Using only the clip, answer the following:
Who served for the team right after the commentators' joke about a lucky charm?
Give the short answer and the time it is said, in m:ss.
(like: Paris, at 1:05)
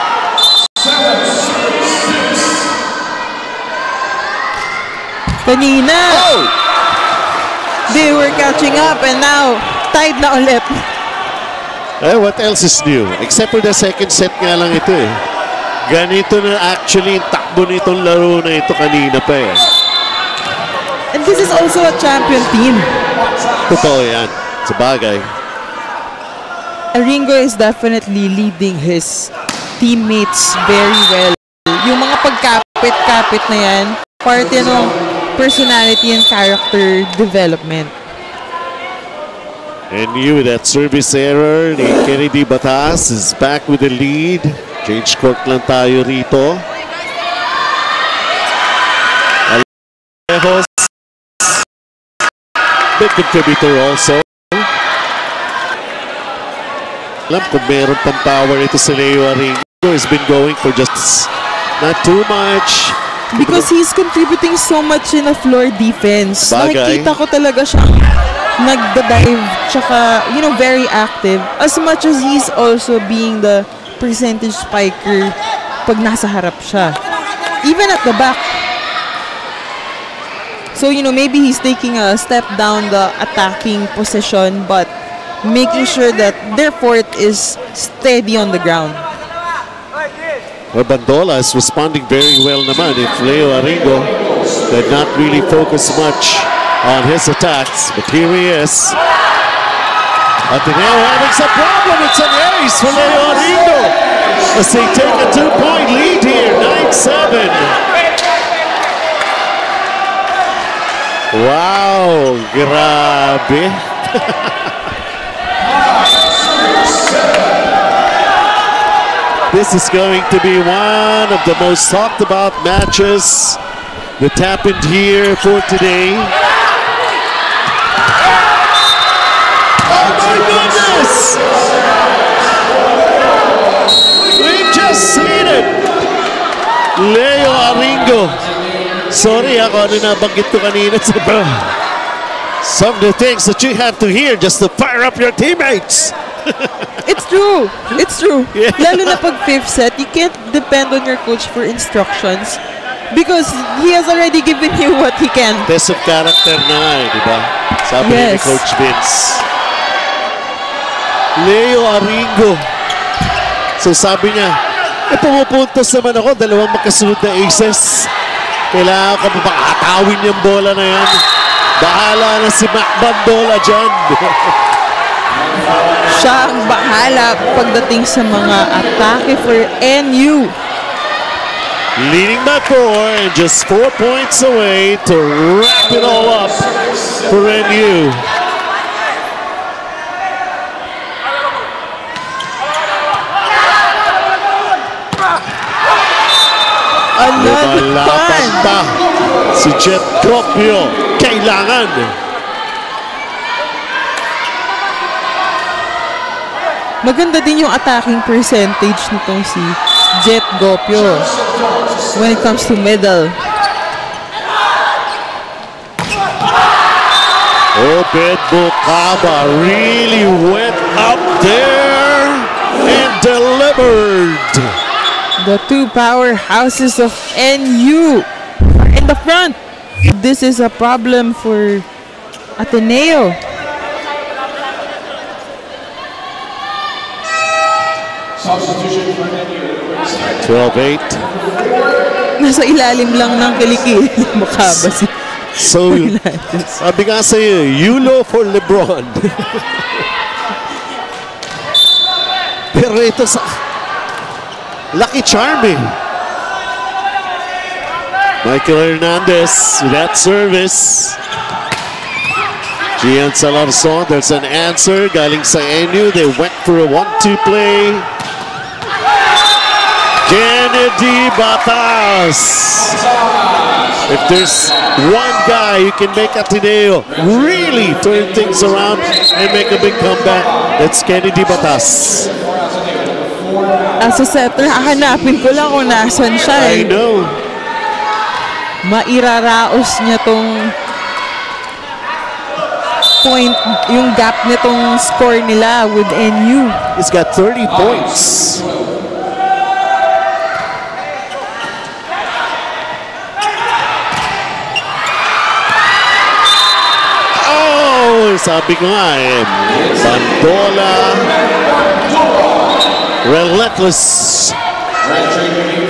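Michael Hernandez, at 4:18.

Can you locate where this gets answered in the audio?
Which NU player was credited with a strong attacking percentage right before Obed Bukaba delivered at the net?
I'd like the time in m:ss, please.
3:19.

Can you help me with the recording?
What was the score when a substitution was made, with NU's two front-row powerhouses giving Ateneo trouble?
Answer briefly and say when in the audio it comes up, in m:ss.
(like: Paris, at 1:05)
12-8, at 4:00.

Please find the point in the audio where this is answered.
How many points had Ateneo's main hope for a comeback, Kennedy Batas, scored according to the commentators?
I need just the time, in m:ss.
4:57.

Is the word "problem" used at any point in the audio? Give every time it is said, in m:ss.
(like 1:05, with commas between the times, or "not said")
1:41, 3:50.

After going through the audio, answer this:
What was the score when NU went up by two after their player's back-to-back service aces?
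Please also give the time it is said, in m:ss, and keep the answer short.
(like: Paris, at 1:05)
9-7, at 1:46.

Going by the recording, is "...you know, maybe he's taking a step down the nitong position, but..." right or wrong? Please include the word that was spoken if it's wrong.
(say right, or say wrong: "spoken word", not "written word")
wrong: "attacking", not "nitong".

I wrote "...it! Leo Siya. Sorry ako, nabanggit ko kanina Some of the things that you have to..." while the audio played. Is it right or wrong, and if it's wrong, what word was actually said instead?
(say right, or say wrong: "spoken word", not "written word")
wrong: "Aringo", not "Siya".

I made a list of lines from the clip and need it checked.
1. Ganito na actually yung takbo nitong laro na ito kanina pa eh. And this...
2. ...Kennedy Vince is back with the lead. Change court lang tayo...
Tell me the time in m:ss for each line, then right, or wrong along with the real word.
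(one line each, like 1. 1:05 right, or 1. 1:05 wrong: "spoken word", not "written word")
1. 0:15 right
2. 0:42 wrong: "Batas", not "Vince".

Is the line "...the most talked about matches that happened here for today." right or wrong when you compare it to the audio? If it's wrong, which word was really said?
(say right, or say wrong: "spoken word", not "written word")
right.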